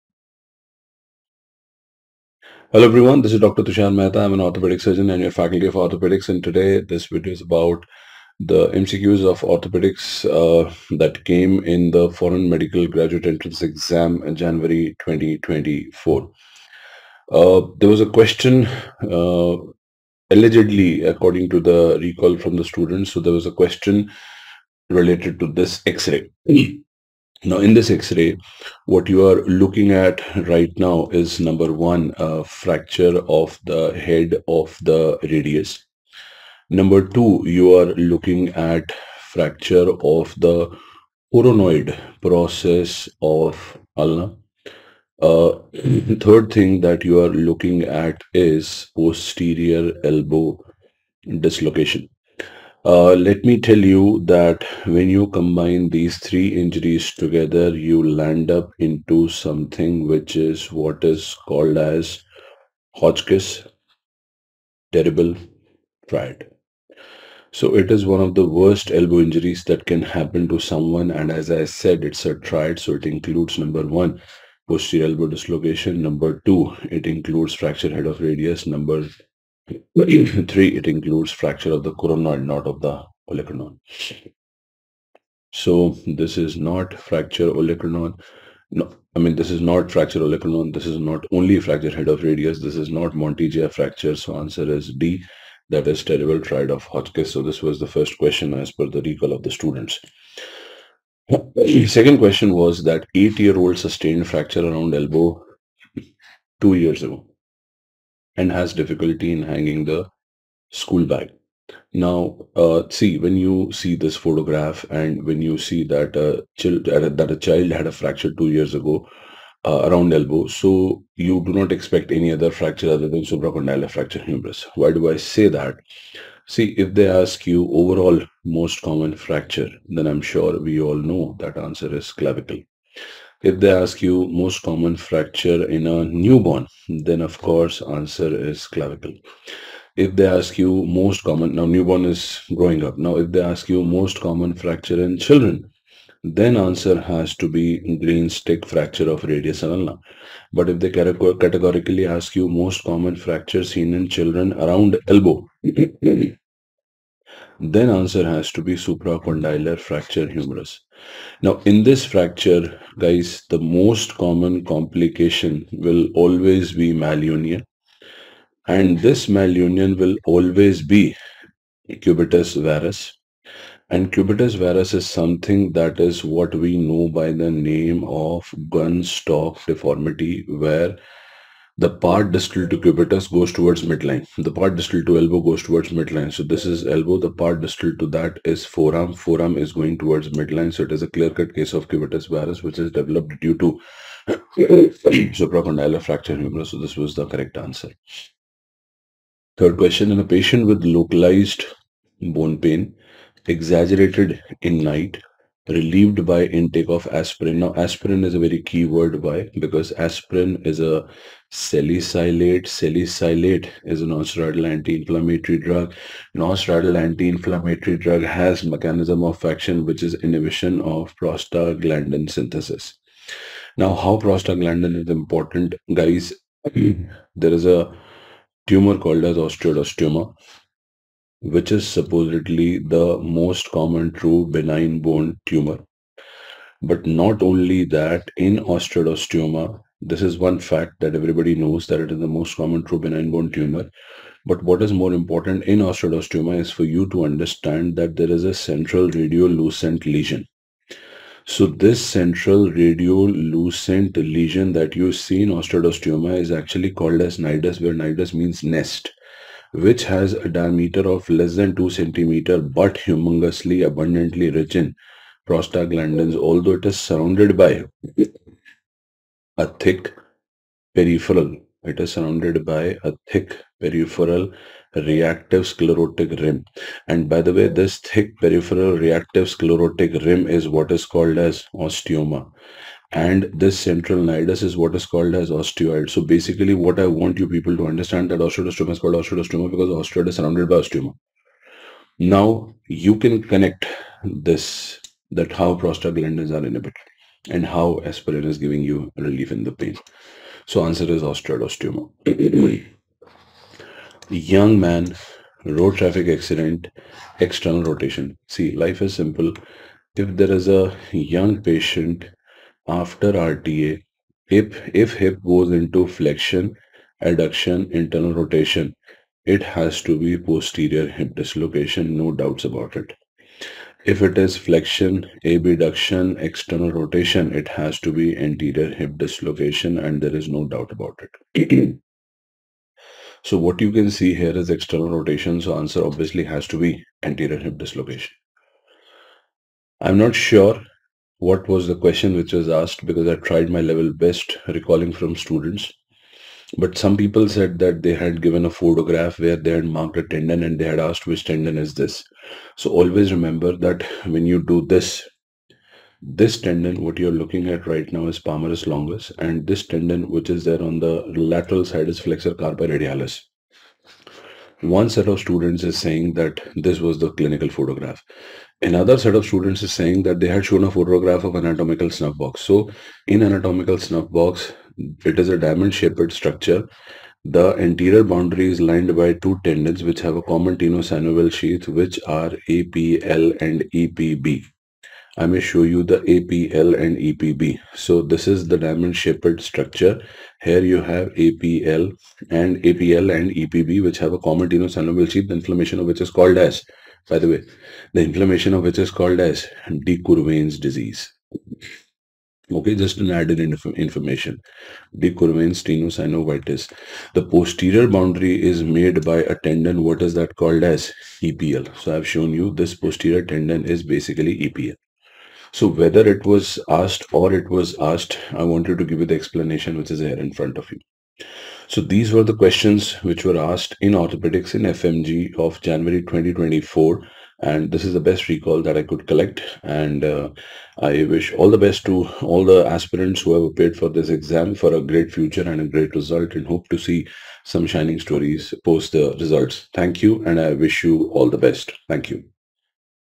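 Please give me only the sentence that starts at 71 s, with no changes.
And as I said, it's a triad.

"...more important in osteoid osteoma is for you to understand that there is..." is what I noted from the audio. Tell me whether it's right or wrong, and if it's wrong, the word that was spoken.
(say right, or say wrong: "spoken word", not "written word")
right.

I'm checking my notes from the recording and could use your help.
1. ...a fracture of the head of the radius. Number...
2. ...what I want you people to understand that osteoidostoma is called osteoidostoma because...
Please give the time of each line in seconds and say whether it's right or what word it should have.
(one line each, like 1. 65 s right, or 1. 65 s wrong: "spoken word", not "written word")
1. 32 s right
2. 286 s right.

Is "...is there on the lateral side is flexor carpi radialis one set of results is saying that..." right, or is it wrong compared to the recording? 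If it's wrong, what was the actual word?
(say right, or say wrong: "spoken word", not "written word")
wrong: "students", not "results".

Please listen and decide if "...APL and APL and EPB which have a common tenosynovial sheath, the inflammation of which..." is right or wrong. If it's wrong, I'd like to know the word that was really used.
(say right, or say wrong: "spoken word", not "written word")
right.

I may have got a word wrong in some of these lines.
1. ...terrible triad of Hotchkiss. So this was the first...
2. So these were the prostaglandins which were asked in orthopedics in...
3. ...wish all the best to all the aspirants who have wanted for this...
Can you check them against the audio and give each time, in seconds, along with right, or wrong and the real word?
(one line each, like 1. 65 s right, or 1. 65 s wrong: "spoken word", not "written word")
1. 96 s right
2. 421 s wrong: "questions", not "prostaglandins"
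3. 431 s wrong: "appeared", not "wanted".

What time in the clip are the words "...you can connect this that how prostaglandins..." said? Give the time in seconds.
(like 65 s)
292 s.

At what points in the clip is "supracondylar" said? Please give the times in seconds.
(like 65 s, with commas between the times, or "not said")
123 s, 158 s, 195 s.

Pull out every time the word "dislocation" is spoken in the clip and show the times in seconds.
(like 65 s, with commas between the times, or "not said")
51 s, 75 s, 321 s, 329 s, 337 s.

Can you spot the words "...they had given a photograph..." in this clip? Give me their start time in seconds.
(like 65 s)
348 s.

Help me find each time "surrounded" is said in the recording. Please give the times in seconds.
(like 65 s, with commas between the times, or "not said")
266 s, 272 s, 290 s.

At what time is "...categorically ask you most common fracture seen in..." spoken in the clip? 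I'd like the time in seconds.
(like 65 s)
150 s.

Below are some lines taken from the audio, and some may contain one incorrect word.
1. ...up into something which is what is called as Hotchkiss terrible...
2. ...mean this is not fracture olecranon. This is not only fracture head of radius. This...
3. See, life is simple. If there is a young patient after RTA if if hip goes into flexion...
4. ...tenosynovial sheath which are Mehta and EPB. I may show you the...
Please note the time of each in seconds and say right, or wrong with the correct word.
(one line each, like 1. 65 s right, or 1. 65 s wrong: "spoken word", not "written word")
1. 58 s right
2. 89 s right
3. 308 s right
4. 380 s wrong: "APL", not "Mehta".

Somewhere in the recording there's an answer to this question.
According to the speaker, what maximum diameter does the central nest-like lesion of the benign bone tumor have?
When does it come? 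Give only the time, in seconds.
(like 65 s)
261 s.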